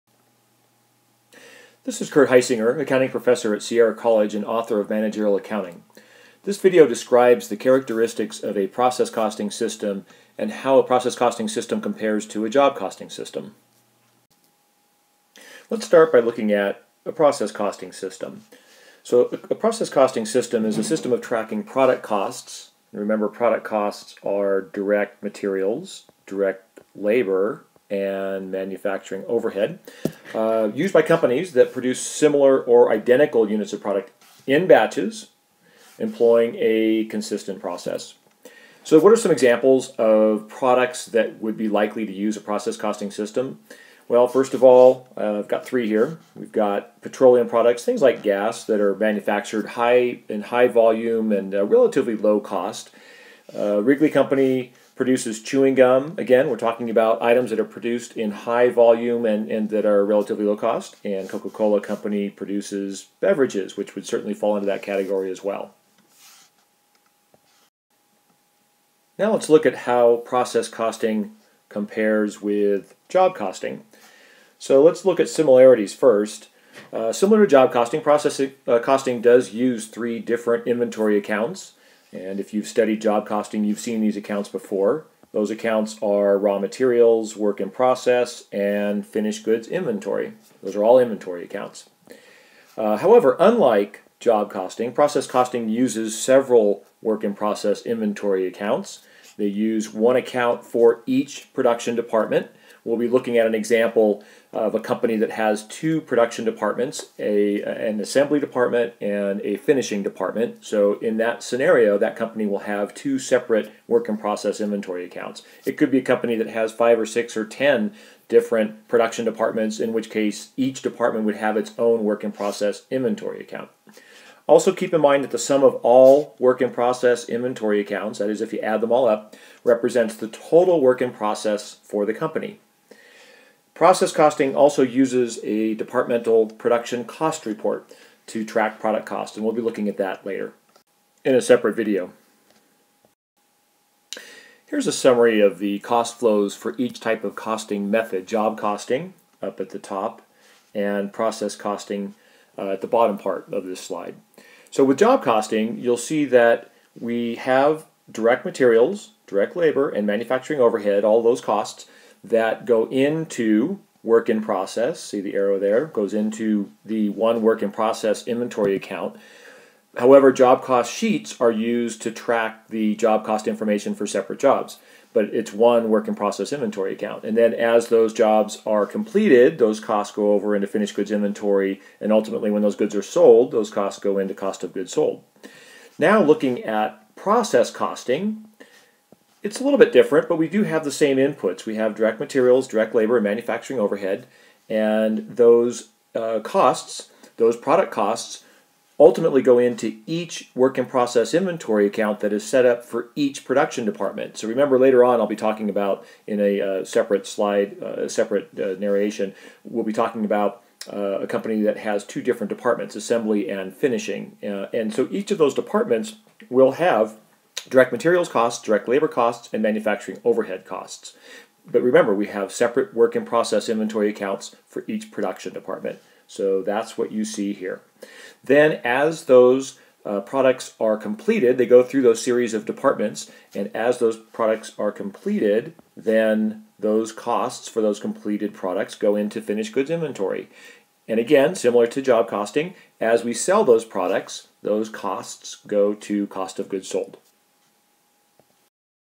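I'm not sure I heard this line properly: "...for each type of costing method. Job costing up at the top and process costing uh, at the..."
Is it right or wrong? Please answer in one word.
right.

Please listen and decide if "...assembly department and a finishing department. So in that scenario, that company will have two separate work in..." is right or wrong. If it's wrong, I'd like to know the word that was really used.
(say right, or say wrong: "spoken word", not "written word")
right.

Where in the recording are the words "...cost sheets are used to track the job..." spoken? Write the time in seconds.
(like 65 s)
170 s.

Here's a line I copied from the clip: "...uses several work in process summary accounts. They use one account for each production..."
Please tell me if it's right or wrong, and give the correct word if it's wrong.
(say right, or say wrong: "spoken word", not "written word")
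wrong: "inventory", not "summary".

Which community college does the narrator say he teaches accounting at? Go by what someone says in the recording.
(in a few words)
Sierra College.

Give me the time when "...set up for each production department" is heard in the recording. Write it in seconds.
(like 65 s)
202 s.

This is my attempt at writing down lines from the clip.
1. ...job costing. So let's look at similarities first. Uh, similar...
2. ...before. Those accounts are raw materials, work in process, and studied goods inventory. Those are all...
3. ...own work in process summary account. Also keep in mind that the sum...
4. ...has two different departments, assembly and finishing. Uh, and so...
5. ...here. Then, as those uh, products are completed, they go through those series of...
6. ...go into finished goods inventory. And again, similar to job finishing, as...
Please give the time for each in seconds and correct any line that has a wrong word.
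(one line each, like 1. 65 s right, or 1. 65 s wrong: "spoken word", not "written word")
1. 73 s right
2. 84 s wrong: "finished", not "studied"
3. 121 s wrong: "inventory", not "summary"
4. 211 s right
5. 227 s right
6. 238 s wrong: "costing", not "finishing".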